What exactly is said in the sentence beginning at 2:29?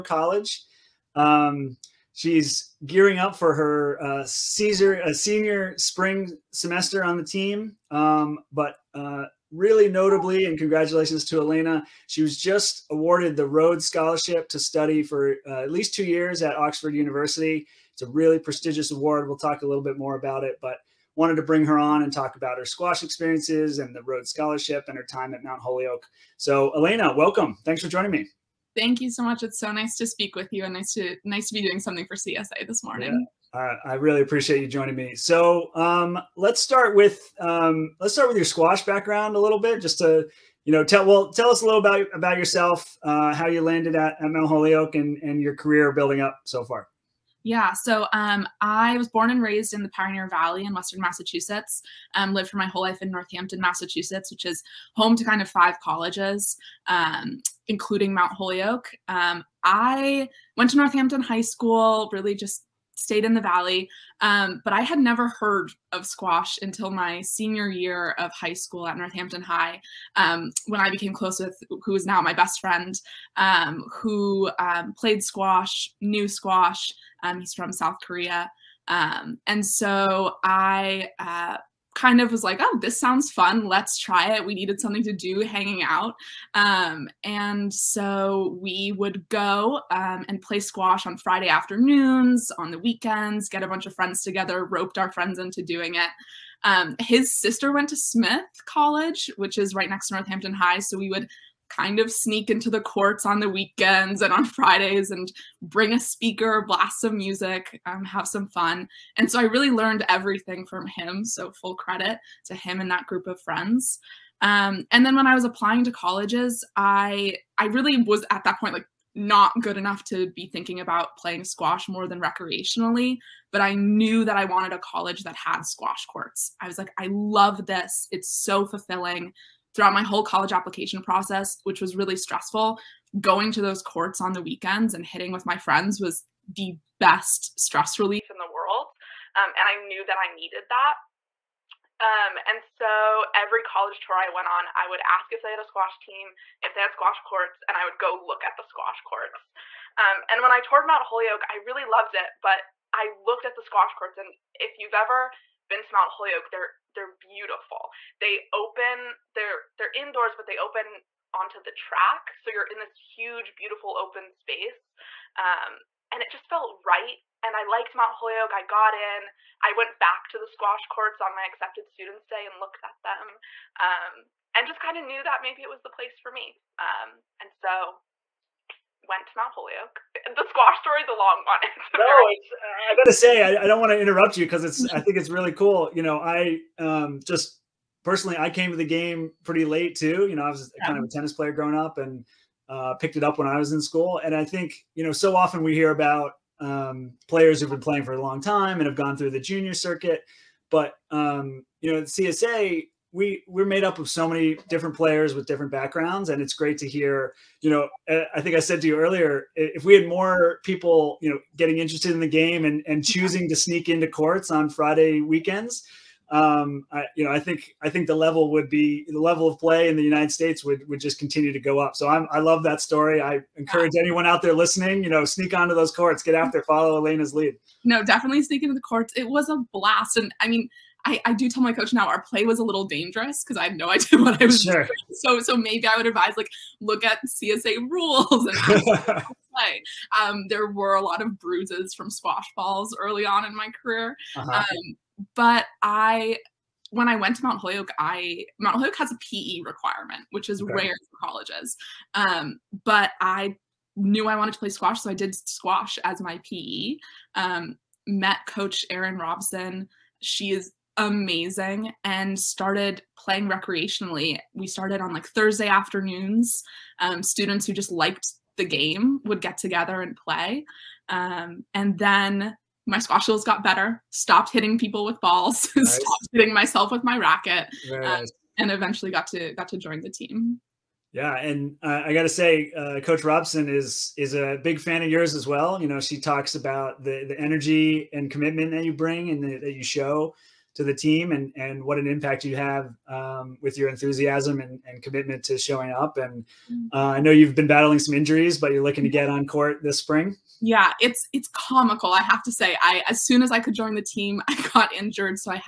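Um, and when I toured Mount Holyoke, I really loved it, but I looked at the squash courts.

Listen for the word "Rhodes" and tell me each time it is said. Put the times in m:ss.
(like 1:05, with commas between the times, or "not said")
0:13, 0:24.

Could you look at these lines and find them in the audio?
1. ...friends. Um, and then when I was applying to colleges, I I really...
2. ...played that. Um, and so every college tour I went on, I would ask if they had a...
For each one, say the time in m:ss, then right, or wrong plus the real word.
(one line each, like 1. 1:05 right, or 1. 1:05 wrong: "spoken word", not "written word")
1. 1:53 right
2. 2:20 wrong: "needed", not "played".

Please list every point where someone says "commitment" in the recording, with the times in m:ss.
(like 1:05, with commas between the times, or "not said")
4:48, 4:55.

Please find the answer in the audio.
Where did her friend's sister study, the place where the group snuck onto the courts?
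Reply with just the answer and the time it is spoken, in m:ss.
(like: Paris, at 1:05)
Smith College, at 1:37.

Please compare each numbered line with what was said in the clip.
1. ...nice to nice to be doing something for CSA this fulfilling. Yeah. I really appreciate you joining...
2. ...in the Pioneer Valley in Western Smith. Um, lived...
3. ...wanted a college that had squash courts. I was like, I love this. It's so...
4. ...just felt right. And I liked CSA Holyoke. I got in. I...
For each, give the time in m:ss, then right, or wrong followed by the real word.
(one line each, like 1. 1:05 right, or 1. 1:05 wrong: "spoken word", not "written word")
1. 0:30 wrong: "morning", not "fulfilling"
2. 0:49 wrong: "Massachusetts", not "Smith"
3. 2:04 right
4. 2:46 wrong: "Mount", not "CSA".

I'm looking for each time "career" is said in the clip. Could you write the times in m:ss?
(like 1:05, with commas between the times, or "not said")
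0:45, 4:03.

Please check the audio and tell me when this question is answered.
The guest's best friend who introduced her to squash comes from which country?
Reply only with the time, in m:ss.
1:17.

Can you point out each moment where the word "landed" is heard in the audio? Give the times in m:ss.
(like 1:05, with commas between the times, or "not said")
0:43.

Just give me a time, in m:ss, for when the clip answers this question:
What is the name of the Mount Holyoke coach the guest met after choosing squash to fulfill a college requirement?
4:18.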